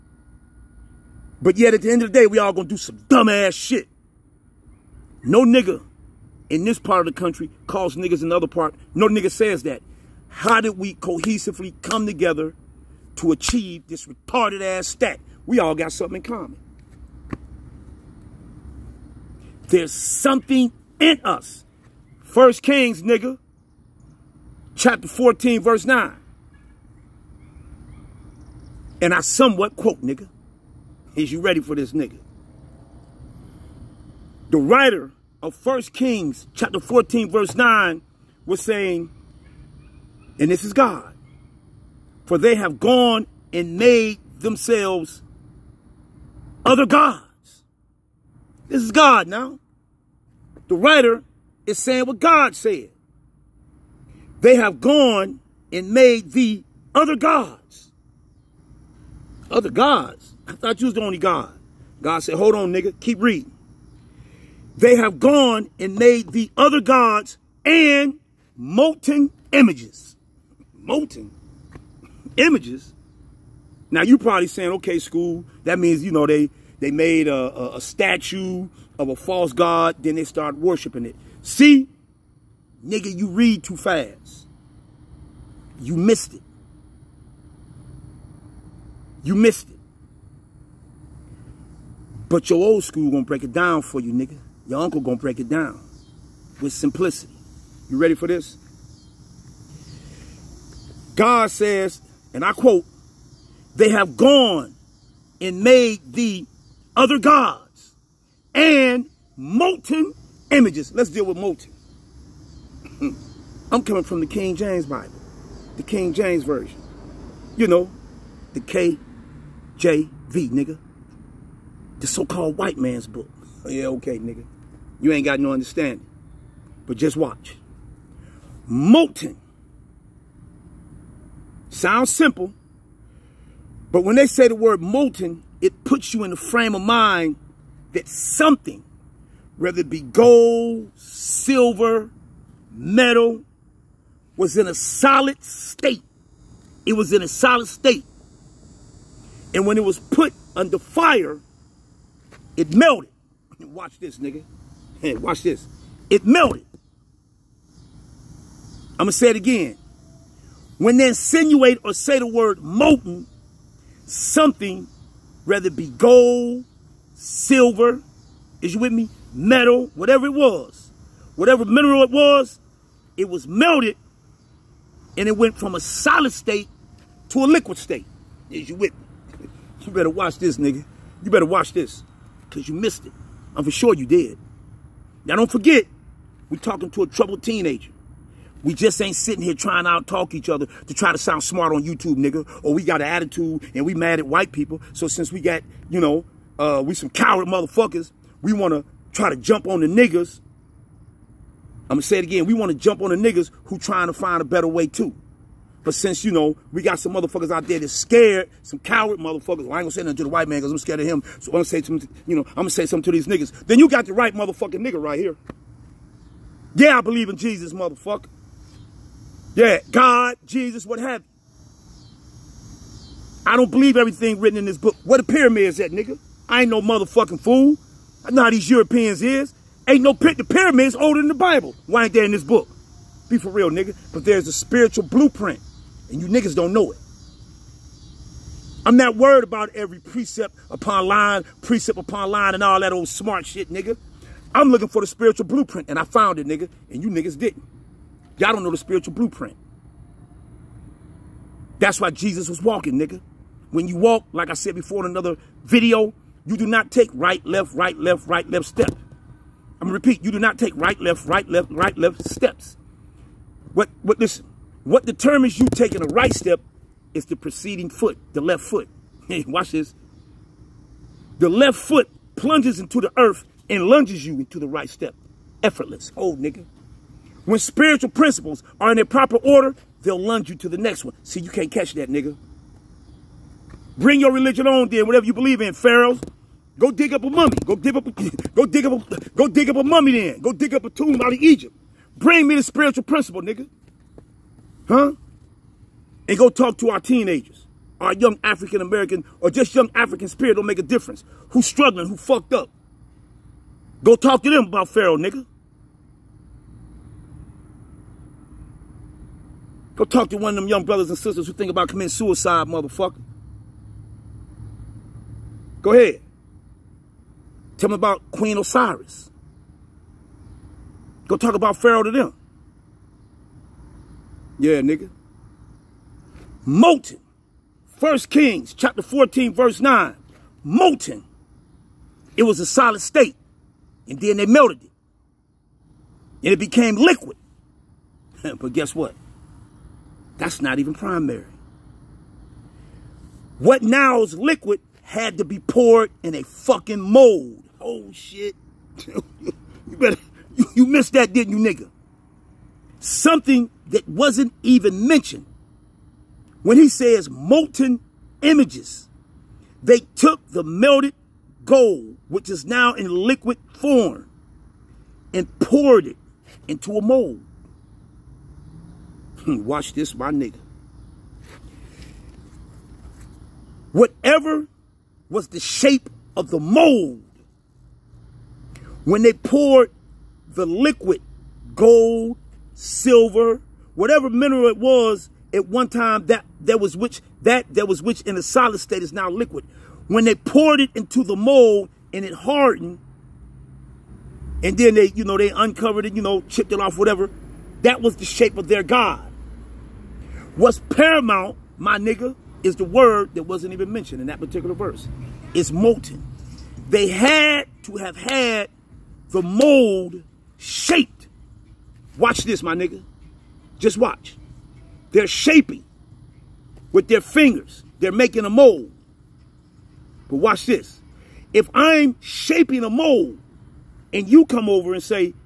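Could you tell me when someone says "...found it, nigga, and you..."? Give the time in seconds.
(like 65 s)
246 s.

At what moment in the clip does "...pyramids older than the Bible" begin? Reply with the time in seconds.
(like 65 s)
230 s.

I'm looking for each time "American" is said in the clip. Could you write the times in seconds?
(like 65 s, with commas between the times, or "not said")
298 s.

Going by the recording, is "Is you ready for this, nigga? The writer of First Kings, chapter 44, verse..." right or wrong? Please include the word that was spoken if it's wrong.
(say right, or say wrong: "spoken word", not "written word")
wrong: "14", not "44".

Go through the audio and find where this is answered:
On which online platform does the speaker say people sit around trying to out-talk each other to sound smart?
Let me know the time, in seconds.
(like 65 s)
191 s.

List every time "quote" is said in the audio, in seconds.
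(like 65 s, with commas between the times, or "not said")
29 s, 102 s.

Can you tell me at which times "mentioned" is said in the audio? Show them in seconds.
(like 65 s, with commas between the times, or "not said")
355 s, 403 s.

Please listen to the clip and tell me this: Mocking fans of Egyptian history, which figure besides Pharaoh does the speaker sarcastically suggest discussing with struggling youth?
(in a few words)
Queen Osiris.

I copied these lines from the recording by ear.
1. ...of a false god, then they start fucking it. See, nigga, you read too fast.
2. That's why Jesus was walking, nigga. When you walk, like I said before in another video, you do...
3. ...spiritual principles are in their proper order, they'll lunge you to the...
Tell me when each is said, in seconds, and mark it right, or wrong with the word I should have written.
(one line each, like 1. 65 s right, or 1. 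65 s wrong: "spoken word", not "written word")
1. 78 s wrong: "worshiping", not "fucking"
2. 251 s right
3. 277 s right.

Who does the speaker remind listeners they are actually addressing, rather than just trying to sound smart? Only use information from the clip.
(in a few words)
A troubled teenager.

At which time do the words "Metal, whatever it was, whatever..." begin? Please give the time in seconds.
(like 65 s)
169 s.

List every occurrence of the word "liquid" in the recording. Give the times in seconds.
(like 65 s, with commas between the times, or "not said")
177 s, 336 s, 344 s, 363 s, 380 s, 389 s.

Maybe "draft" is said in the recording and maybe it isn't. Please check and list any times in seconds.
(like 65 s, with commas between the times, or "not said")
not said.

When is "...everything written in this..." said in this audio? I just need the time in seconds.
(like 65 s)
223 s.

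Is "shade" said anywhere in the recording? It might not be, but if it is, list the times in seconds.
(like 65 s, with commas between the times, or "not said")
not said.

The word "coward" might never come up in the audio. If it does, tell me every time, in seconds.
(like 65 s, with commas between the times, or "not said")
197 s, 208 s.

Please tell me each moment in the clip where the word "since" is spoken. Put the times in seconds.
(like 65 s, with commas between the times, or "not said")
195 s, 205 s.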